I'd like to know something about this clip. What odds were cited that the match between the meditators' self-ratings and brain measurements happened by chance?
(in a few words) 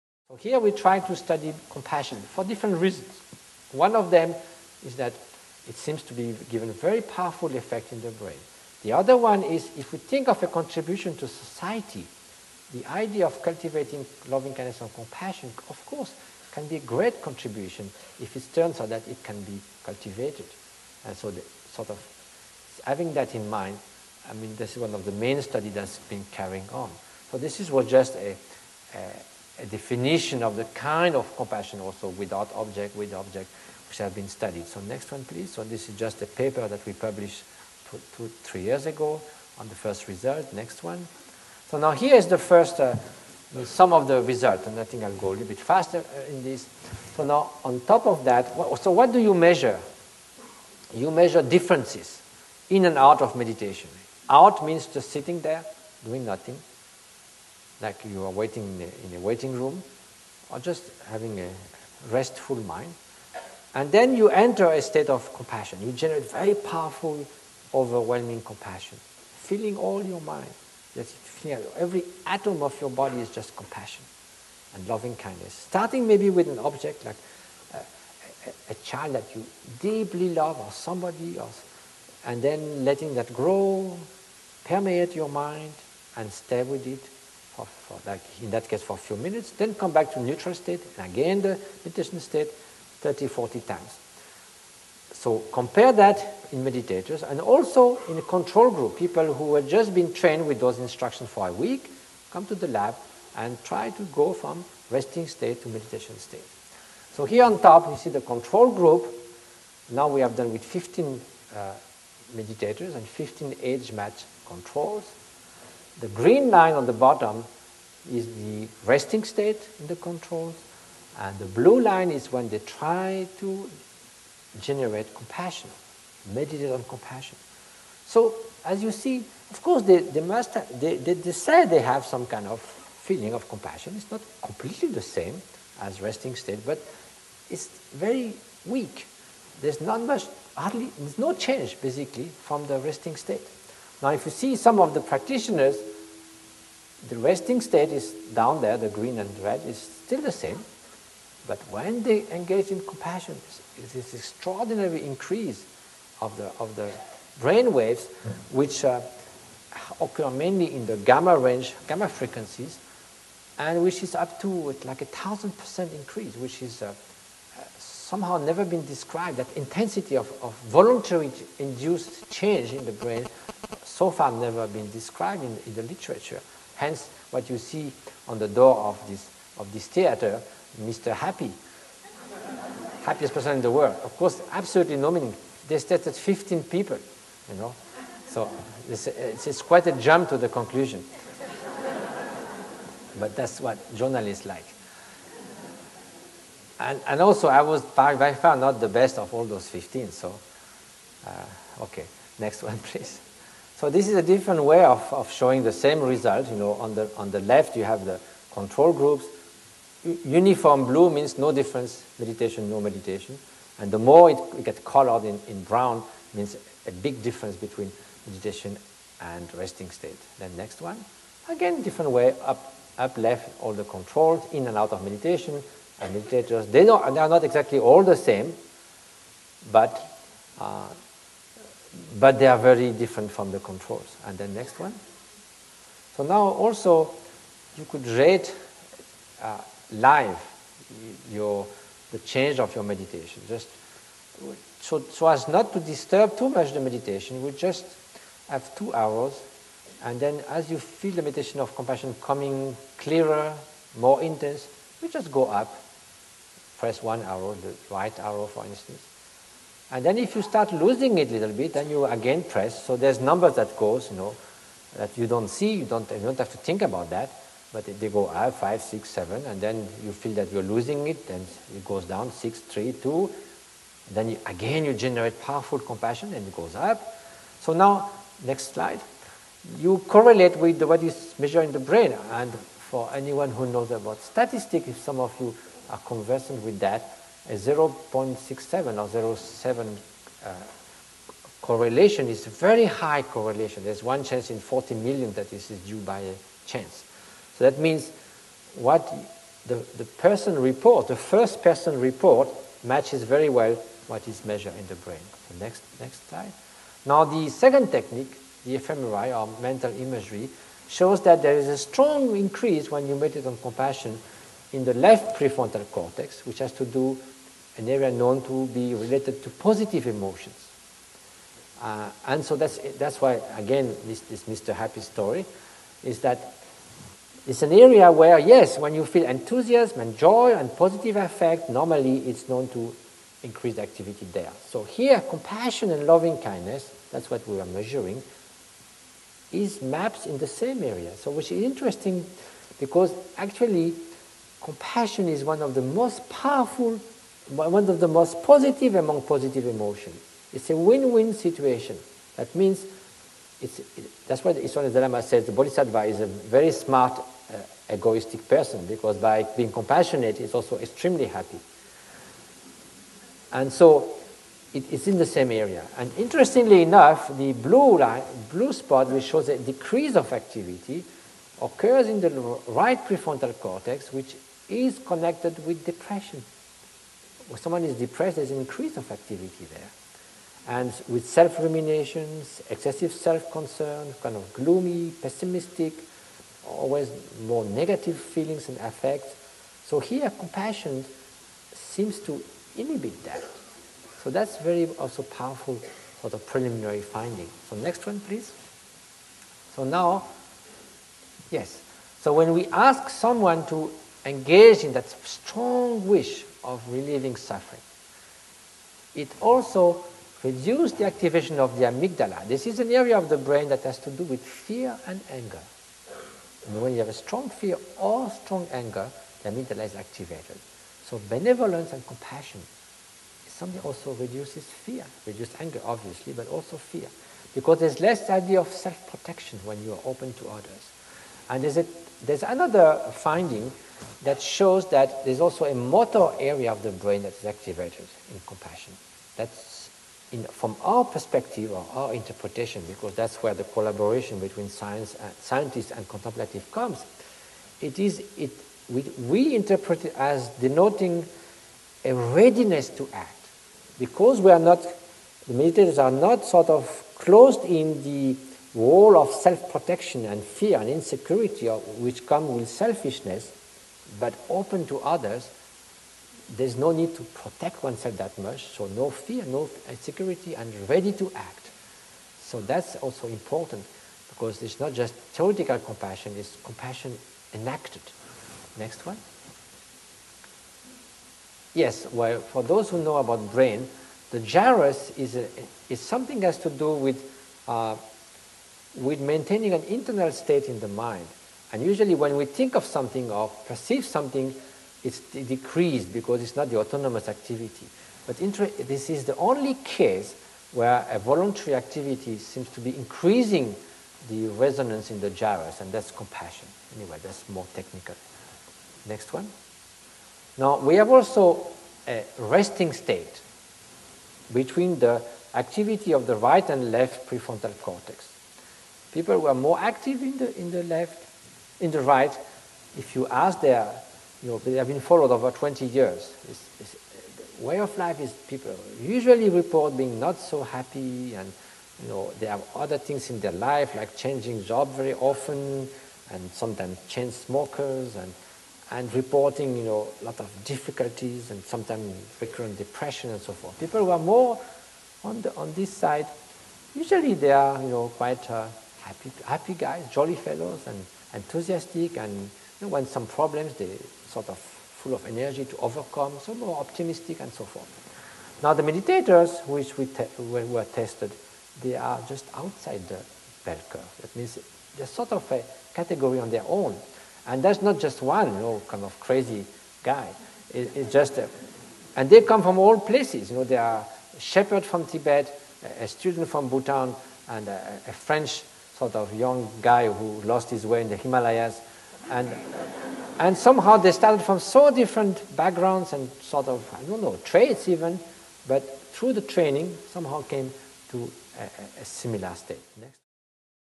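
1 in 40 million.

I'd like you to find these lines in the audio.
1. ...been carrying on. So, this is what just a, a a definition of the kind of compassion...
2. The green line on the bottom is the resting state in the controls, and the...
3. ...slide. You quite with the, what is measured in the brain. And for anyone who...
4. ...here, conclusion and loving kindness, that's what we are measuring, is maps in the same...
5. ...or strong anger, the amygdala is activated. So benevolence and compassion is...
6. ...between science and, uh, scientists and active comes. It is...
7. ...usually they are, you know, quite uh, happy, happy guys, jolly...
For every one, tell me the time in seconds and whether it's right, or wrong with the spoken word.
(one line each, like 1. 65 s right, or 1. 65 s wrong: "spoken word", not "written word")
1. 25 s right
2. 115 s right
3. 278 s wrong: "correlate", not "quite"
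4. 334 s wrong: "compassion", not "conclusion"
5. 417 s right
6. 444 s wrong: "contemplative", not "active"
7. 546 s right.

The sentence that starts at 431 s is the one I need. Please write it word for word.
And there's, a, there's another finding that shows that there's also a motor area of the brain that's activated in compassion.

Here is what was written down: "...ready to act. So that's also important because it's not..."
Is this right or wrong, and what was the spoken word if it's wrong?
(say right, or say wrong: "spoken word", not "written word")
right.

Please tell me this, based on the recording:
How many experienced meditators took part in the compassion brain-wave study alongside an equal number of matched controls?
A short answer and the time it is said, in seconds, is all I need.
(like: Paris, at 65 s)
15, at 110 s.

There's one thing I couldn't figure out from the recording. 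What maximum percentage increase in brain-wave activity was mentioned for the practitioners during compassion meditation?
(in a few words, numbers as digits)
1000 percent.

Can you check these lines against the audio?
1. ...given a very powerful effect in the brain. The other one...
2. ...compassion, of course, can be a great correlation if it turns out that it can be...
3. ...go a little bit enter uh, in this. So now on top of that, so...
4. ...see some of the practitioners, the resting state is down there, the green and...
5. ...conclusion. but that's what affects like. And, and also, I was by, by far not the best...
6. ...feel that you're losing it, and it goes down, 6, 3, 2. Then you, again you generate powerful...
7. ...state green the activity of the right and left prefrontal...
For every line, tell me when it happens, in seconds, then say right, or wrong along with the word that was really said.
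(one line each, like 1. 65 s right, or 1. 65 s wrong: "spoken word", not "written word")
1. 6 s right
2. 14 s wrong: "contribution", not "correlation"
3. 45 s wrong: "faster", not "enter"
4. 144 s right
5. 190 s wrong: "journalists", not "affects"
6. 270 s right
7. 512 s wrong: "between", not "green".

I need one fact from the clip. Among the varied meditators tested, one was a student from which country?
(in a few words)
Bhutan.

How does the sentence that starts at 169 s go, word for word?
That intensity of, of voluntary induced change in the brain so far never been described in, in the literature.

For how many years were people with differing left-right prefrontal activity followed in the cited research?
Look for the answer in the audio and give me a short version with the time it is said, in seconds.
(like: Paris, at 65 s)
20, at 525 s.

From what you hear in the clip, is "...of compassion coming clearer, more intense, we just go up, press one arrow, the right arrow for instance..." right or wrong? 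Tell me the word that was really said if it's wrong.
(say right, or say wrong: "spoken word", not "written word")
right.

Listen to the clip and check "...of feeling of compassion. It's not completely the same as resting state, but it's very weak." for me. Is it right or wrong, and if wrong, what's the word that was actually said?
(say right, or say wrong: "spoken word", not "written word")
right.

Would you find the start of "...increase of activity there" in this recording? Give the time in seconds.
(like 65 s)
378 s.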